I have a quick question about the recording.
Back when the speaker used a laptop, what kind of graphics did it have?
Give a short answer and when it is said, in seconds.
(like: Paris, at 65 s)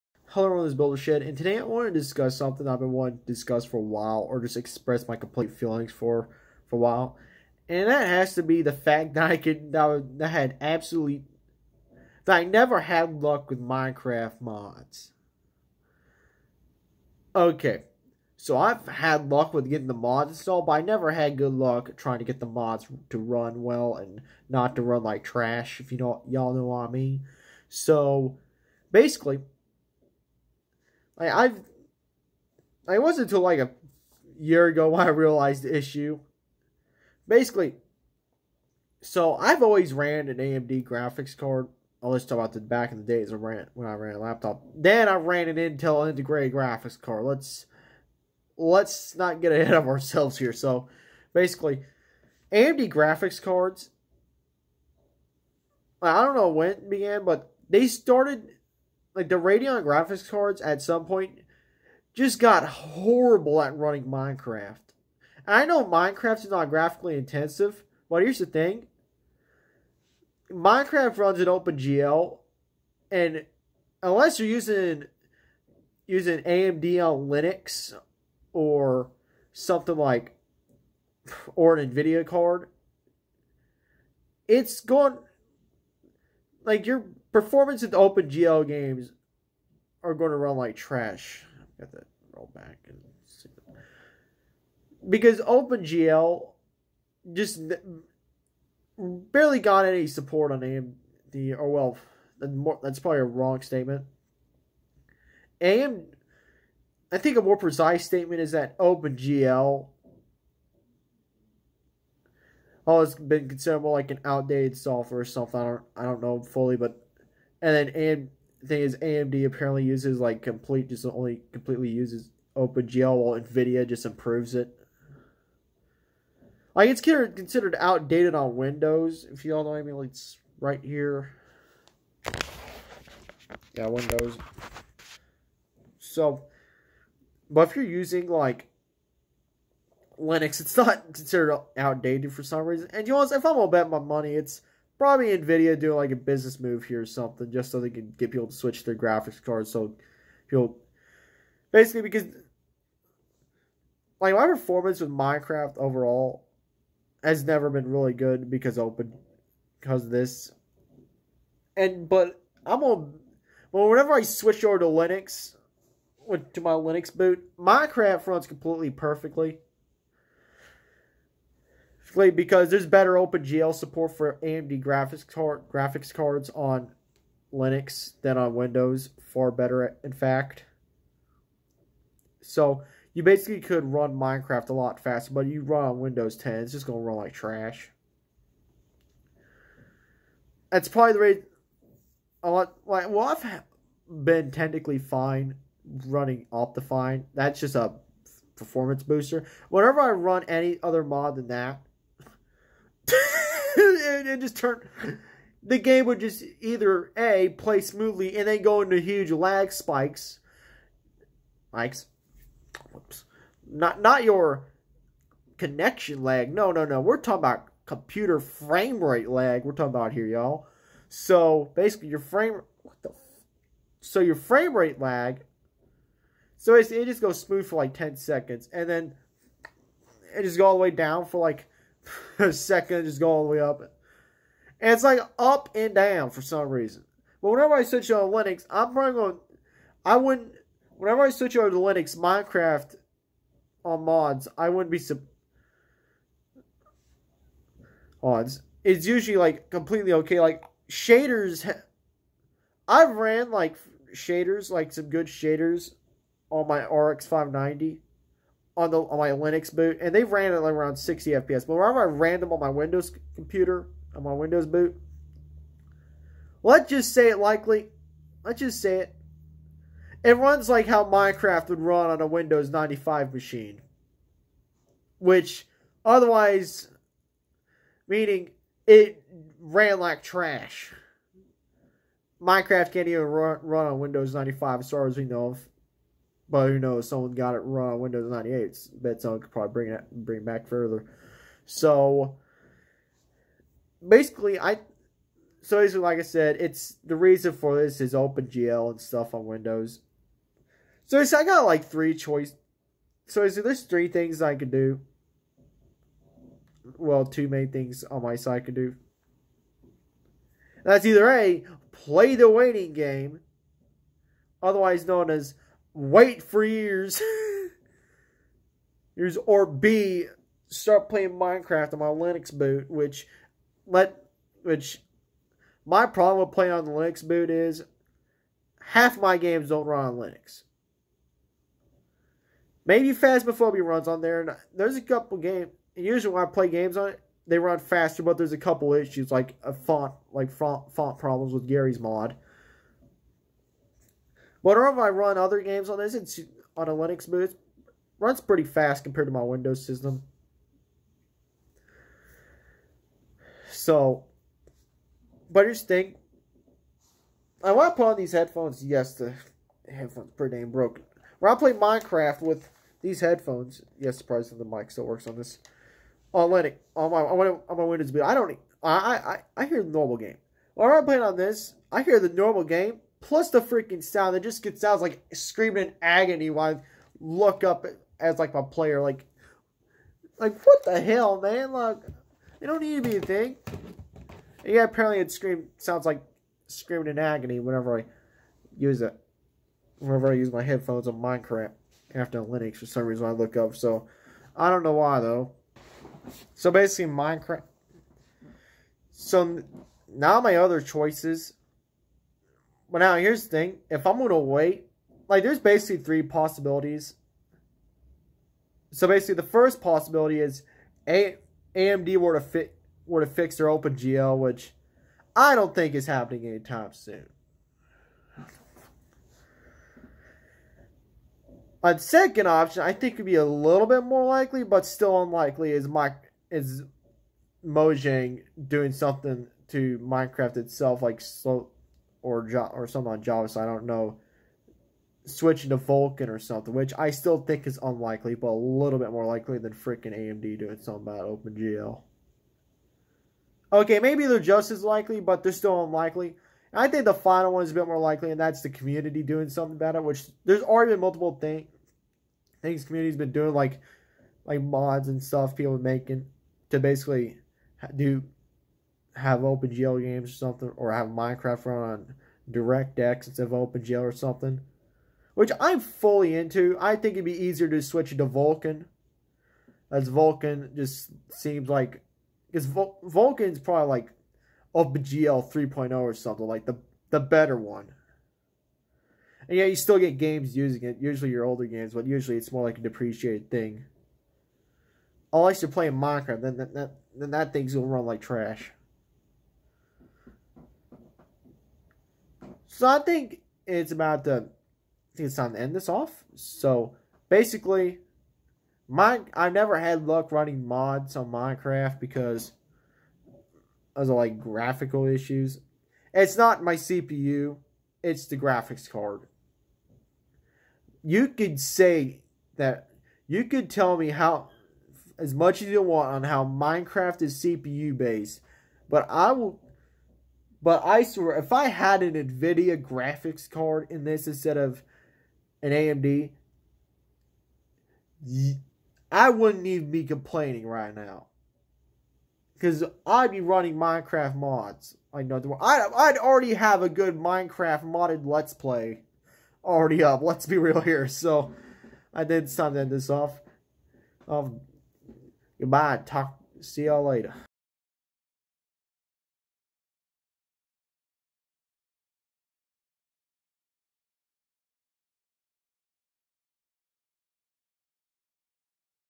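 Intel integrated graphics, at 45 s.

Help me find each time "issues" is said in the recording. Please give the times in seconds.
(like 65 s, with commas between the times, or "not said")
35 s, 338 s, 505 s.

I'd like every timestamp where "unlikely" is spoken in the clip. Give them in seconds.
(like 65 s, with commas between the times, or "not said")
425 s, 437 s, 445 s.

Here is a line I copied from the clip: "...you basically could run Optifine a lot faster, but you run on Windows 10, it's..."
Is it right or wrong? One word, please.
wrong.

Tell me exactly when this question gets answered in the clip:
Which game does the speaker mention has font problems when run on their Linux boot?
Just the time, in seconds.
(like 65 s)
341 s.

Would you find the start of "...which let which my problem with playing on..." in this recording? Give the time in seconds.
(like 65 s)
322 s.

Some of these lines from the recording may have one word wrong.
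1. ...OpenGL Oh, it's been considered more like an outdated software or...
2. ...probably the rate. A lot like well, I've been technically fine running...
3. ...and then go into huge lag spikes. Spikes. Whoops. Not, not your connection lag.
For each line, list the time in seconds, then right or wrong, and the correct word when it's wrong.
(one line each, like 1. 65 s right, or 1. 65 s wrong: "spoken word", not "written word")
1. 108 s right
2. 190 s right
3. 208 s right.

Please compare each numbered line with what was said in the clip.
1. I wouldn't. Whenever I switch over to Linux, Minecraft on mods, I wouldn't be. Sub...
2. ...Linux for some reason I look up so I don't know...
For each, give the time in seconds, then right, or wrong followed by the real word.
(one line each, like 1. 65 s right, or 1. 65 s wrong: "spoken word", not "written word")
1. 240 s right
2. 392 s right.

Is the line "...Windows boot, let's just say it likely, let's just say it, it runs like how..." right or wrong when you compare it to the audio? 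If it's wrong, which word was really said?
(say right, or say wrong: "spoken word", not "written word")
right.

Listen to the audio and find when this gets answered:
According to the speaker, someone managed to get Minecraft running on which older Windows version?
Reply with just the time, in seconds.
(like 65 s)
288 s.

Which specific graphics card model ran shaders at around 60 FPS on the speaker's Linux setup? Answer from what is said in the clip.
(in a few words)
RX 590.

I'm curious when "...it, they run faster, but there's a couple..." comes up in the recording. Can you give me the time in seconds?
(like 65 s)
337 s.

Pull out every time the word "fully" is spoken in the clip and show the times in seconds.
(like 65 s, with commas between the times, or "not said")
116 s, 465 s.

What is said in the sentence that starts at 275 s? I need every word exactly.
Which, otherwise, meaning it ran like trash.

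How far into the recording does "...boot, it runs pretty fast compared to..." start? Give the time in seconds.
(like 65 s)
347 s.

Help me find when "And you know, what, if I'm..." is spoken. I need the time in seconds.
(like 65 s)
142 s.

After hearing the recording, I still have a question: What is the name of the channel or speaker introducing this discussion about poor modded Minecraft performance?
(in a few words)
Builder Shed.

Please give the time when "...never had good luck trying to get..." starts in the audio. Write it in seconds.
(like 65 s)
20 s.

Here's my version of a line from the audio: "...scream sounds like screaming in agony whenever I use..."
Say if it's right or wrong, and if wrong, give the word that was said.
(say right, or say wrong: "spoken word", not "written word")
right.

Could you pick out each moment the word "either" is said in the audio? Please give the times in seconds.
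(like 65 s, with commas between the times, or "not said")
206 s, 311 s.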